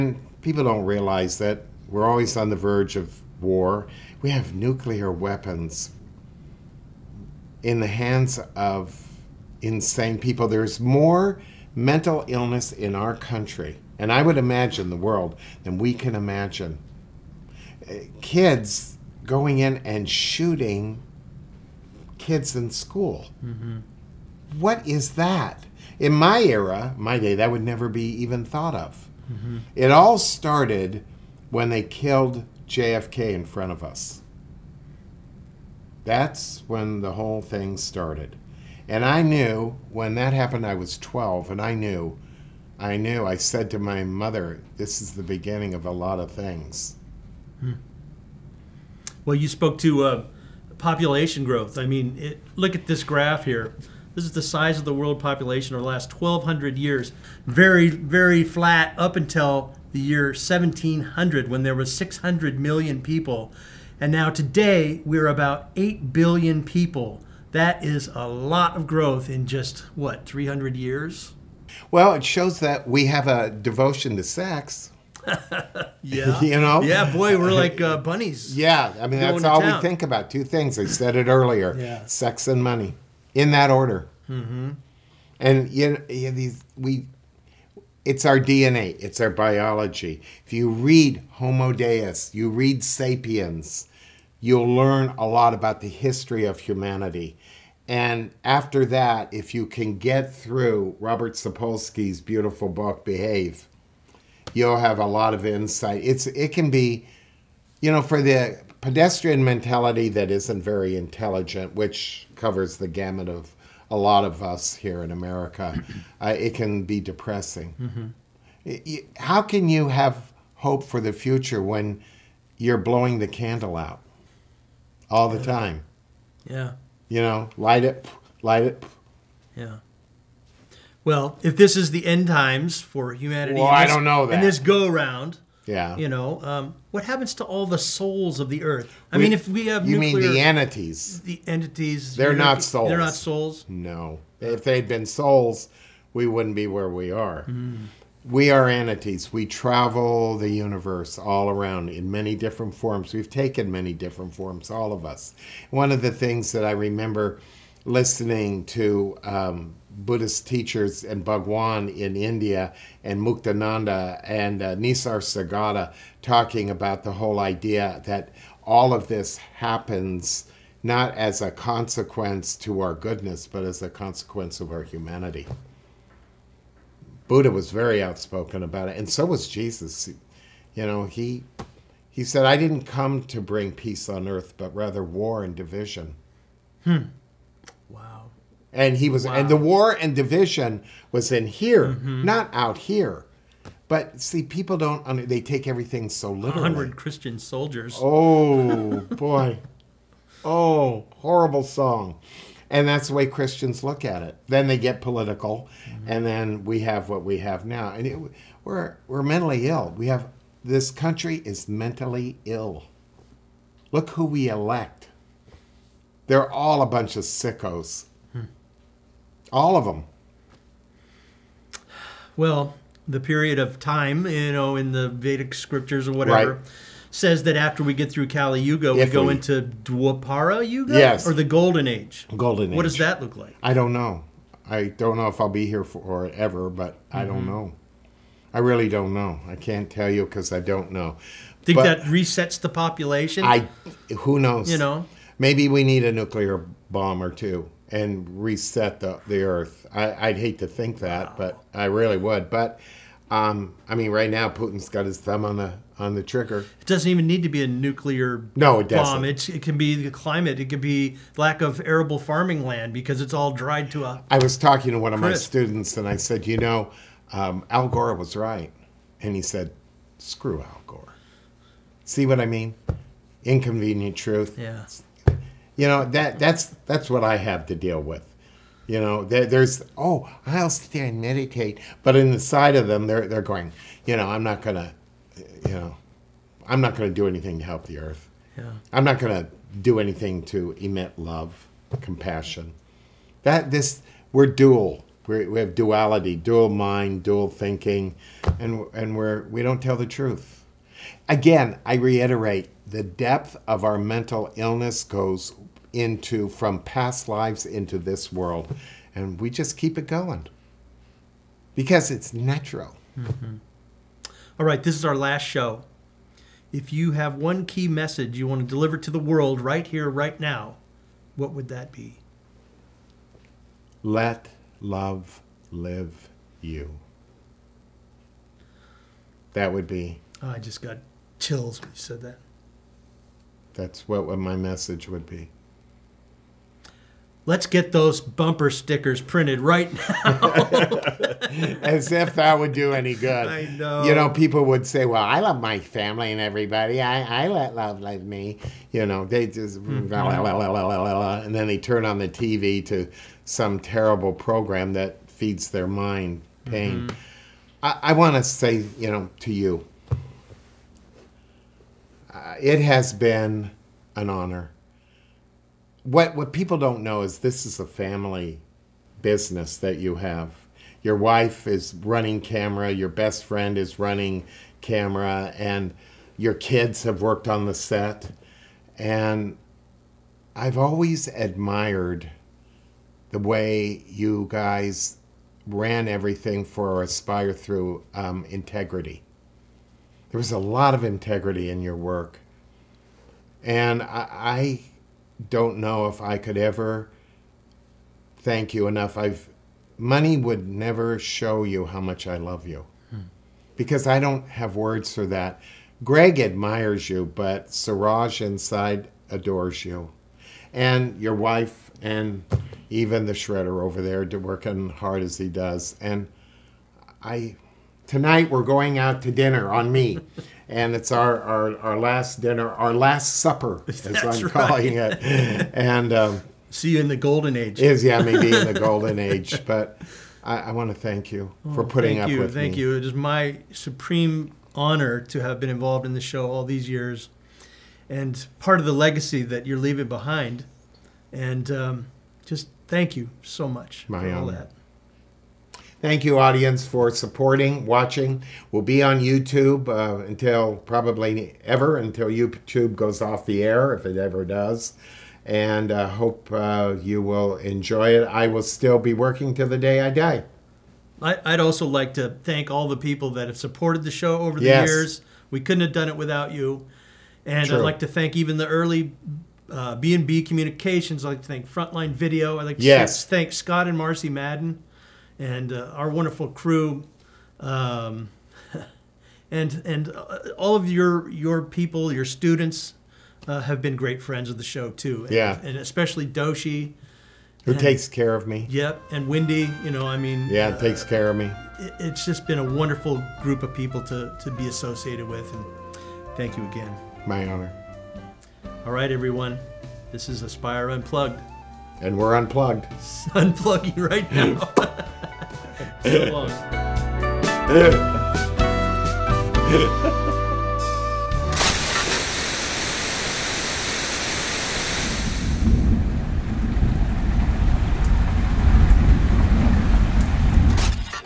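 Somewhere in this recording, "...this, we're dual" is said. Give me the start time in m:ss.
4:53.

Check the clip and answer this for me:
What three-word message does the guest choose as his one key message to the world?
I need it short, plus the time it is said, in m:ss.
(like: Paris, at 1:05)
Let love live, at 5:24.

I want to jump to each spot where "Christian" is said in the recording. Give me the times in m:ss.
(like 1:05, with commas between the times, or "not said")
3:16, 3:23.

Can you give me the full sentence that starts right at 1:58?
it, it, how can you have hope for the future when you're blowing the candle out?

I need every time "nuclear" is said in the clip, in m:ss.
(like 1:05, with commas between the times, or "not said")
0:04, 2:19, 4:06, 4:17.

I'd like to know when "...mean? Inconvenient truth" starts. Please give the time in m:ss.
4:32.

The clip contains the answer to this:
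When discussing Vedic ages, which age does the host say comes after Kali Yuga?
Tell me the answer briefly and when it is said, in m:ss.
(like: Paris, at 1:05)
Dwapara Yuga, at 3:49.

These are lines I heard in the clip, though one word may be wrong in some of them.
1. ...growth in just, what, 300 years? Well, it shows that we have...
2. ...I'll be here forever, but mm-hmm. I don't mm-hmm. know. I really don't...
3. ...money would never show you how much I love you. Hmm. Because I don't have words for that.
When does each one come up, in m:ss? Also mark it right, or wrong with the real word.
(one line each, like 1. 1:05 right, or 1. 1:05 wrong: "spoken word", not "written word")
1. 1:08 right
2. 3:55 right
3. 6:39 right.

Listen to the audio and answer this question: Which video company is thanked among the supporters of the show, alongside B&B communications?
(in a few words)
Frontline Video.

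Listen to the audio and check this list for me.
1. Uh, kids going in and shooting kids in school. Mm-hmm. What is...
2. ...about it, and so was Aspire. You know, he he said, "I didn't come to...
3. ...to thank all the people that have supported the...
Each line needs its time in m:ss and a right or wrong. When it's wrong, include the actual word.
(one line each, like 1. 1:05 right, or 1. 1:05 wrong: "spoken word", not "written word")
1. 0:17 right
2. 2:58 wrong: "Jesus", not "Aspire"
3. 7:42 right.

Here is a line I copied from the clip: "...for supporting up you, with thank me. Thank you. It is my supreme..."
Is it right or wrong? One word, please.
wrong.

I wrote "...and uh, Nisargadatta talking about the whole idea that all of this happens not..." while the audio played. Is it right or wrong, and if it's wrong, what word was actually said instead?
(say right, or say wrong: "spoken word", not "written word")
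right.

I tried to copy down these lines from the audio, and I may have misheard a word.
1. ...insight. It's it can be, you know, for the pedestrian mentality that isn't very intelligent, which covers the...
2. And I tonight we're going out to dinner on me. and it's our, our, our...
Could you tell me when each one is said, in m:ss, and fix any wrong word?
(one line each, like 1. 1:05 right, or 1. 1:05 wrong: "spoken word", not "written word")
1. 1:45 right
2. 6:55 right.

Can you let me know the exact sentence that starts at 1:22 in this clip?
sex and money, in that order.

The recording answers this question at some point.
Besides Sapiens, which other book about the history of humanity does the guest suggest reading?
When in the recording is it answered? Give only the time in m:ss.
1:31.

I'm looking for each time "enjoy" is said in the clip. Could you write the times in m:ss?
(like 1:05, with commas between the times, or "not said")
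7:37.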